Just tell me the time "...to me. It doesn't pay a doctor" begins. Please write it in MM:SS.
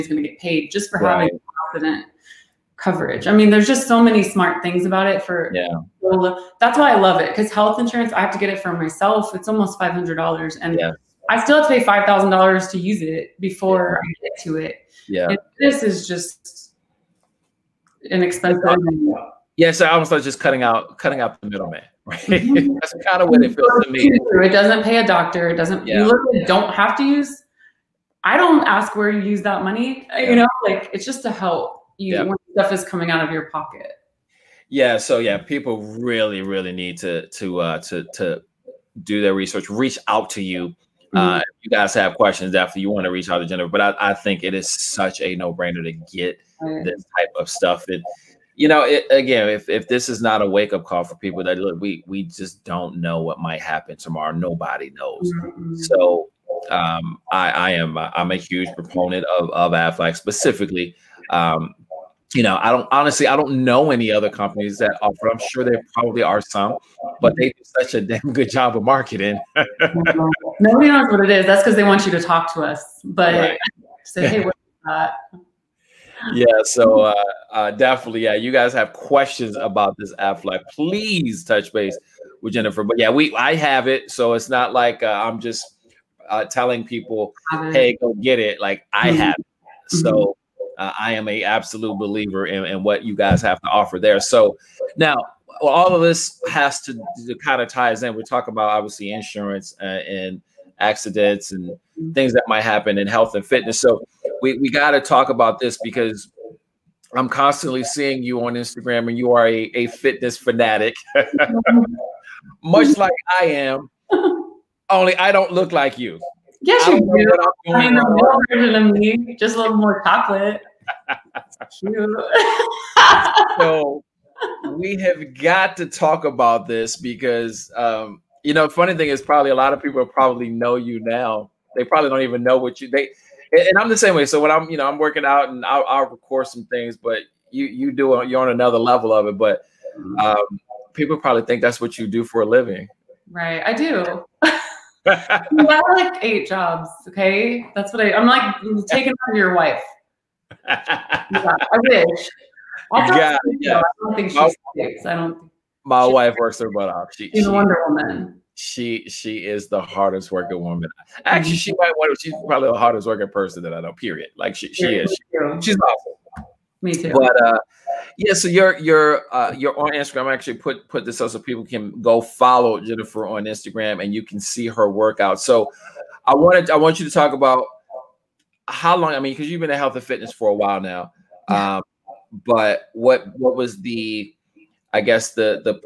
00:23.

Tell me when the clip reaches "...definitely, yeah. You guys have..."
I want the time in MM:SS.
01:17.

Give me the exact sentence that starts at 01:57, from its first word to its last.
I mean, the real version of me, just a little more chocolate.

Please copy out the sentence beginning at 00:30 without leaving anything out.
You know, like it's just to help you yeah stuff is coming out of your pocket.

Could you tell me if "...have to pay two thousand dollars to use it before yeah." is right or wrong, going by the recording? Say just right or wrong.
wrong.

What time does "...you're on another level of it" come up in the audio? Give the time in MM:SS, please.
02:18.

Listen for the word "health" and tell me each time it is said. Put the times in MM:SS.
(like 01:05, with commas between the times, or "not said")
00:07, 01:43, 02:59.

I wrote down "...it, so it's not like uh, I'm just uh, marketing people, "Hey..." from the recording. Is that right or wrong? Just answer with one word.
wrong.